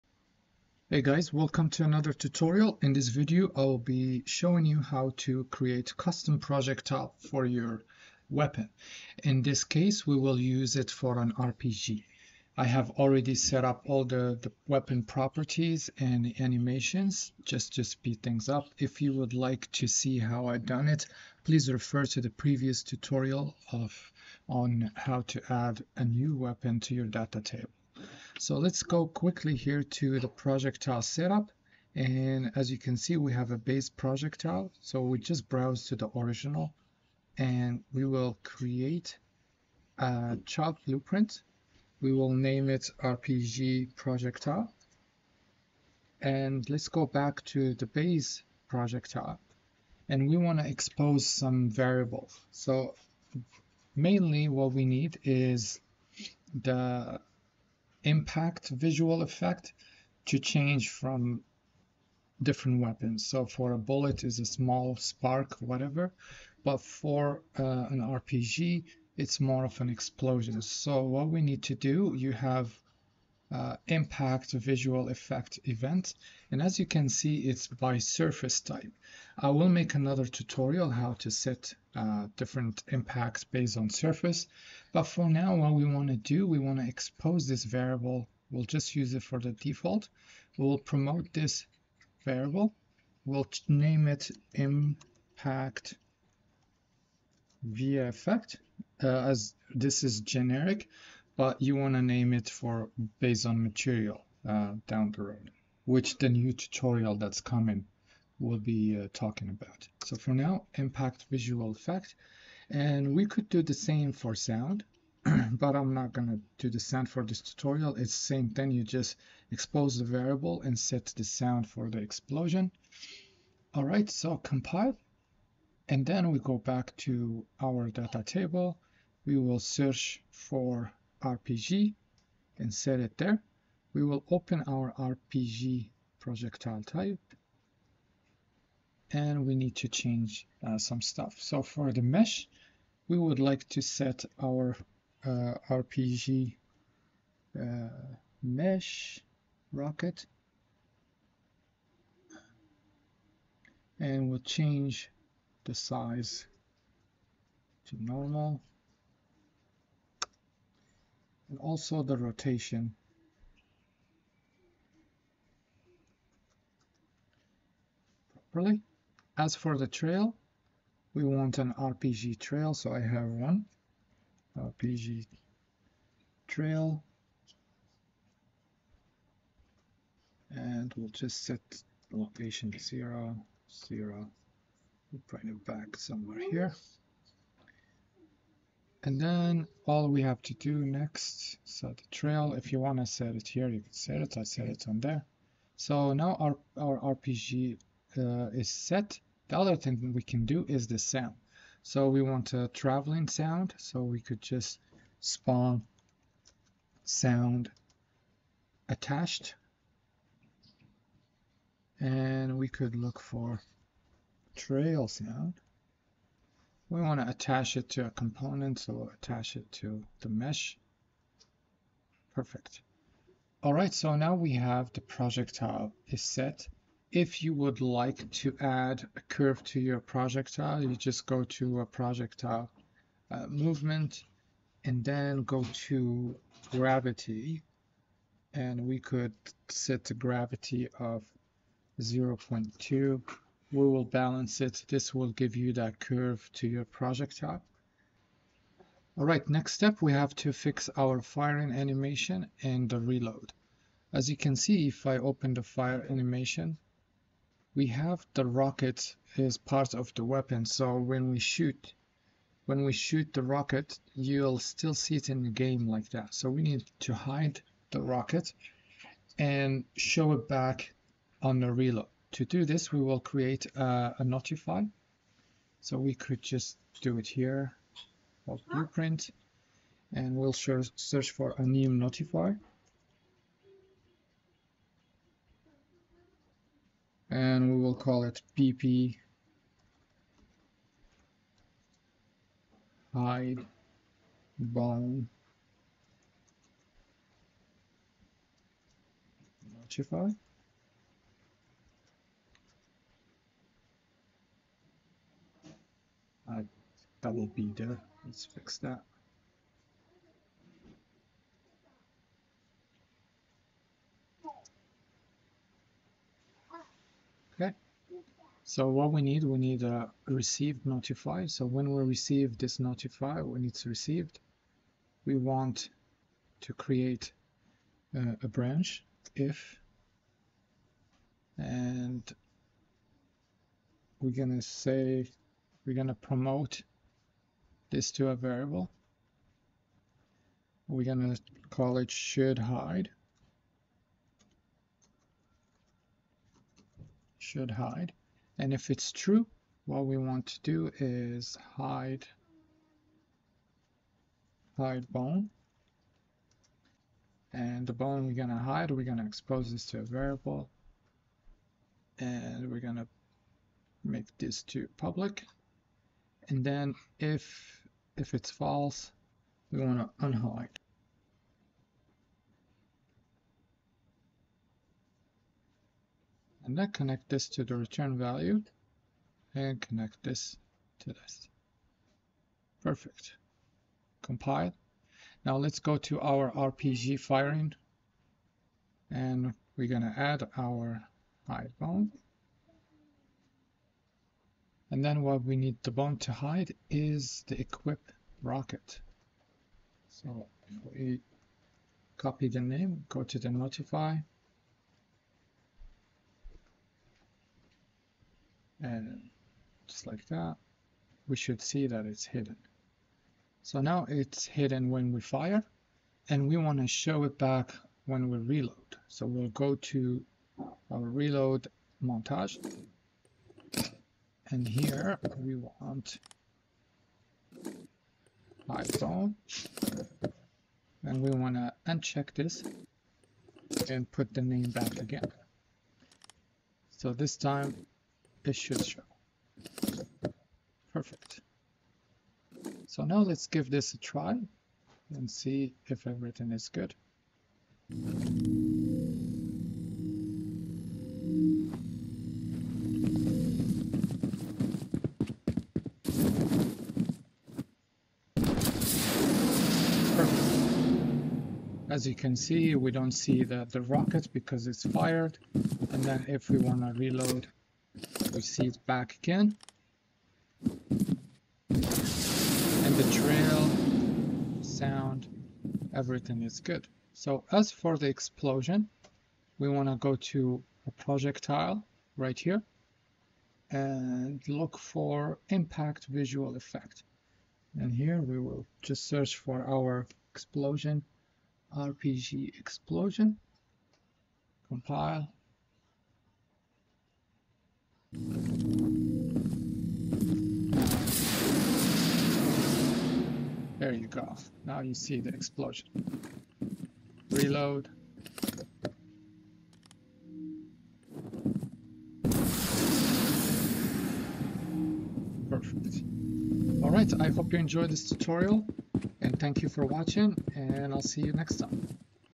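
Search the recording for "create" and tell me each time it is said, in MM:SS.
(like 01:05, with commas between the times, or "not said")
00:05, 00:38, 04:33, 05:26.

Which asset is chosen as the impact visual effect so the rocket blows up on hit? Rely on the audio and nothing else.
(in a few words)
RPG Explosion.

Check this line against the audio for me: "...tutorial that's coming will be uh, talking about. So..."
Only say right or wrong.
right.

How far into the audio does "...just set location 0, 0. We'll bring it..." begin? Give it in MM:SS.
03:01.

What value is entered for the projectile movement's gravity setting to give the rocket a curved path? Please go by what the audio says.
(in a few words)
0.2.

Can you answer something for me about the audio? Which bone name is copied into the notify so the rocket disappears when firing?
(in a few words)
equip rocket.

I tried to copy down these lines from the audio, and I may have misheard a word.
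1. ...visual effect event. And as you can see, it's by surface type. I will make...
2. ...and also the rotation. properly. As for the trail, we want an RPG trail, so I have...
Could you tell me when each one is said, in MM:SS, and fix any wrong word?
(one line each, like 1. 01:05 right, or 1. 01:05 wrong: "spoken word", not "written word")
1. 01:14 right
2. 02:41 right.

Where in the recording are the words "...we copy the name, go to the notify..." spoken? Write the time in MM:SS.
06:40.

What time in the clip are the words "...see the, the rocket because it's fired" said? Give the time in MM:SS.
07:43.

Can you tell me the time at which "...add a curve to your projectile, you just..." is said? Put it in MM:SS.
03:48.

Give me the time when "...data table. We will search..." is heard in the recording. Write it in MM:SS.
02:07.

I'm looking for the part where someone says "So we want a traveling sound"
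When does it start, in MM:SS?
03:21.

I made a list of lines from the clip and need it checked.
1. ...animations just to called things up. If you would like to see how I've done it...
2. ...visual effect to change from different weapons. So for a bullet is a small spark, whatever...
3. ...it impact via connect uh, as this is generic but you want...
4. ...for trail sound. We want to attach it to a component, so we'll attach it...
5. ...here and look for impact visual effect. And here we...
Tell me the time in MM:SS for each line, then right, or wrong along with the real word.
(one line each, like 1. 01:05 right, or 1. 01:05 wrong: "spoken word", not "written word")
1. 00:16 wrong: "speed", not "called"
2. 00:58 right
3. 01:34 wrong: "effect", not "connect"
4. 03:33 right
5. 08:02 right.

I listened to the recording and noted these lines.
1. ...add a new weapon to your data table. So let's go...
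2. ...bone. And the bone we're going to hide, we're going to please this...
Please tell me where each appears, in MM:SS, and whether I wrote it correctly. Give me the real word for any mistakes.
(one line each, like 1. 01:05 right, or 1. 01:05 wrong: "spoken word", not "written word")
1. 00:25 right
2. 05:55 wrong: "expose", not "please".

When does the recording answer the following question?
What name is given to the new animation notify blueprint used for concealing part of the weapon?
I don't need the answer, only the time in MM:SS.
04:48.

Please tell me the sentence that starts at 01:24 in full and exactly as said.
But for now, what we want to do, we want to expose this variable.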